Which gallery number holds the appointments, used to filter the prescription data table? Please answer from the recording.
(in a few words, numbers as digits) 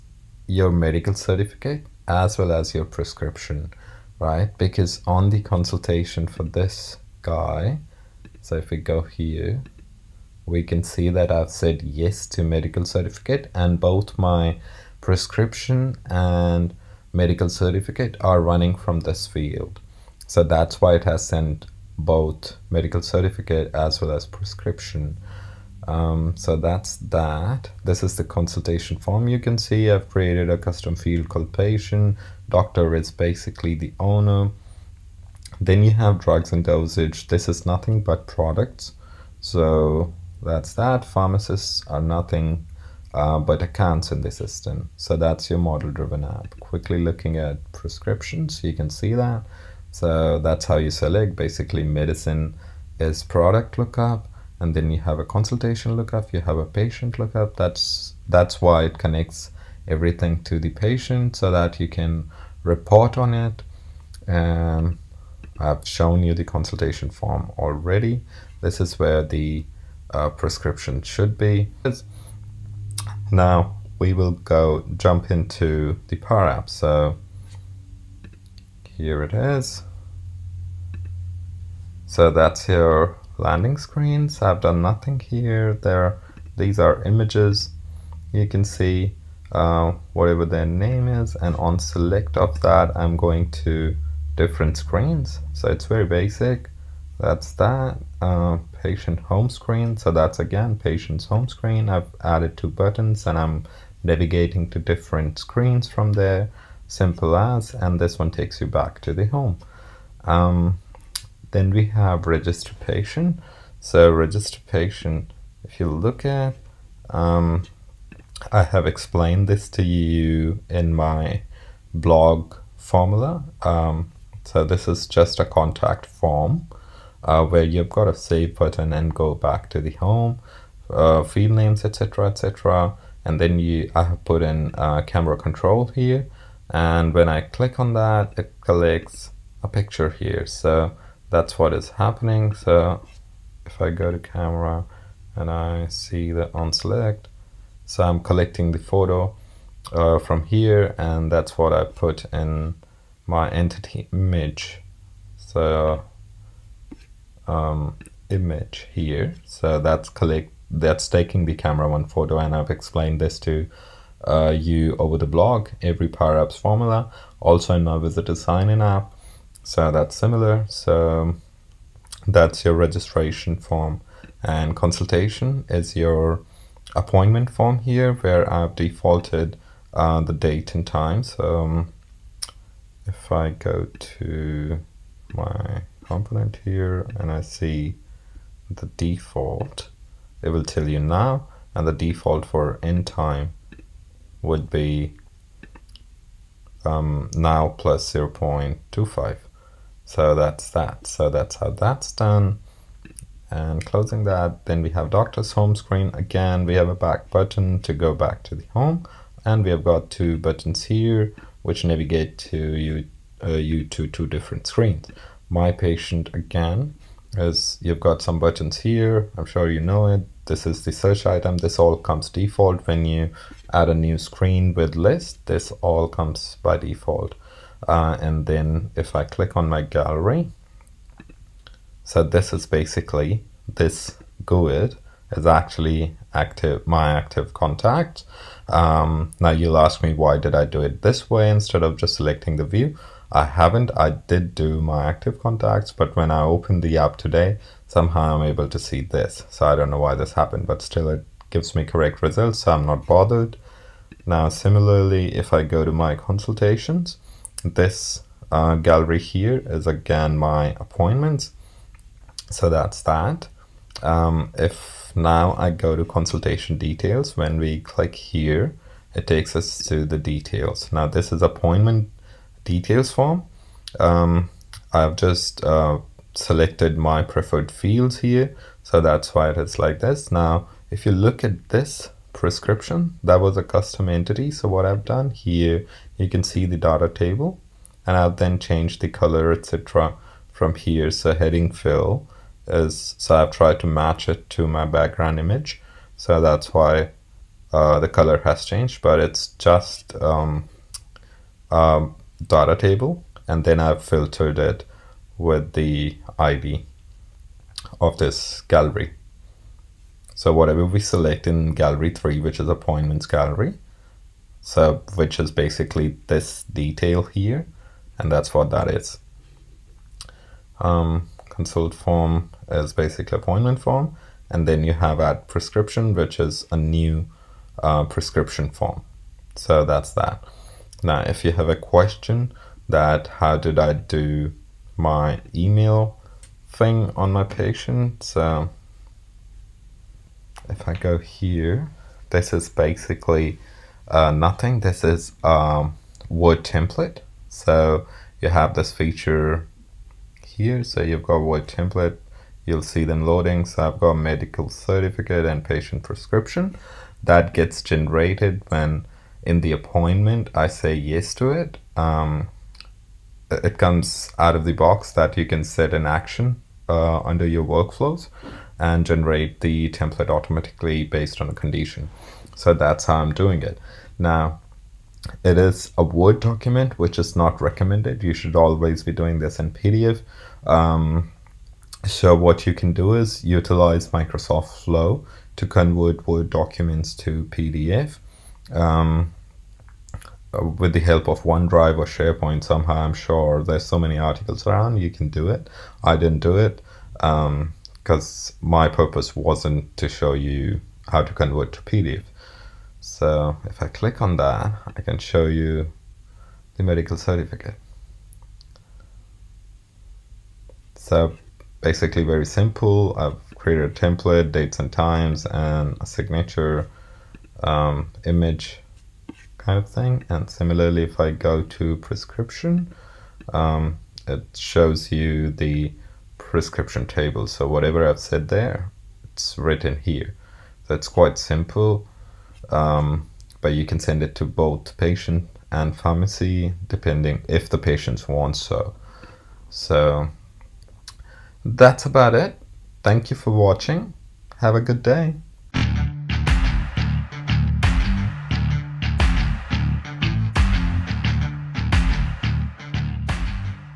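3.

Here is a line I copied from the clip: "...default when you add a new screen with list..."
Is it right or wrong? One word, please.
right.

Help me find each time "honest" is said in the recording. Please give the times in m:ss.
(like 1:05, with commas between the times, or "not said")
not said.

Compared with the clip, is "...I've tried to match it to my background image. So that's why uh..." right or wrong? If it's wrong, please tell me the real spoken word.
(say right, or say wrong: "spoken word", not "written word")
right.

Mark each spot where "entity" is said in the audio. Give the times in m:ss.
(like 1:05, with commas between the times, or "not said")
2:33, 4:44.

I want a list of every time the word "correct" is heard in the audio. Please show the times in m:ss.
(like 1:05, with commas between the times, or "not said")
4:11.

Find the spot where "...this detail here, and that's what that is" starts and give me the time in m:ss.
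5:16.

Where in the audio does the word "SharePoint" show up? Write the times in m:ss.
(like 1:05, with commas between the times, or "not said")
6:32.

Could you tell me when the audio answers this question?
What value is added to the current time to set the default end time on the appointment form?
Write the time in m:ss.
3:18.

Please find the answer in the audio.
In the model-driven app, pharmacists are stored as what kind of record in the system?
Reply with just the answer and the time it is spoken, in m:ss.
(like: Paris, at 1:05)
Accounts, at 0:43.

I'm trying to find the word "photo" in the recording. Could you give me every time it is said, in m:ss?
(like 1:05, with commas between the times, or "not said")
2:28, 2:42.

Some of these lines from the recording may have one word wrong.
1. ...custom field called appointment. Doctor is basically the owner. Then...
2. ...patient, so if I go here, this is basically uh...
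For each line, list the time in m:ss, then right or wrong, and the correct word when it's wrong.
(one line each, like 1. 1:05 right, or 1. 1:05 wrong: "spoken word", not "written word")
1. 0:30 wrong: "patient", not "appointment"
2. 5:37 right.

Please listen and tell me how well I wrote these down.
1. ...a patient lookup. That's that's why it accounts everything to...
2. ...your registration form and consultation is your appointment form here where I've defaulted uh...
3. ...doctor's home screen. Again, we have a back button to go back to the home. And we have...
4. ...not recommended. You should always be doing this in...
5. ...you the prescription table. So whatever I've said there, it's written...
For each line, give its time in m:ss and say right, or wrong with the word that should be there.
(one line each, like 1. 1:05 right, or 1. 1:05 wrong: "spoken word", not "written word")
1. 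0:56 wrong: "connects", not "accounts"
2. 2:52 right
3. 3:25 right
4. 6:17 right
5. 7:05 right.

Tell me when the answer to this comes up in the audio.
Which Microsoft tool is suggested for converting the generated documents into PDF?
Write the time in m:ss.
6:24.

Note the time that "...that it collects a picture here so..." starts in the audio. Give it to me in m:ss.
2:17.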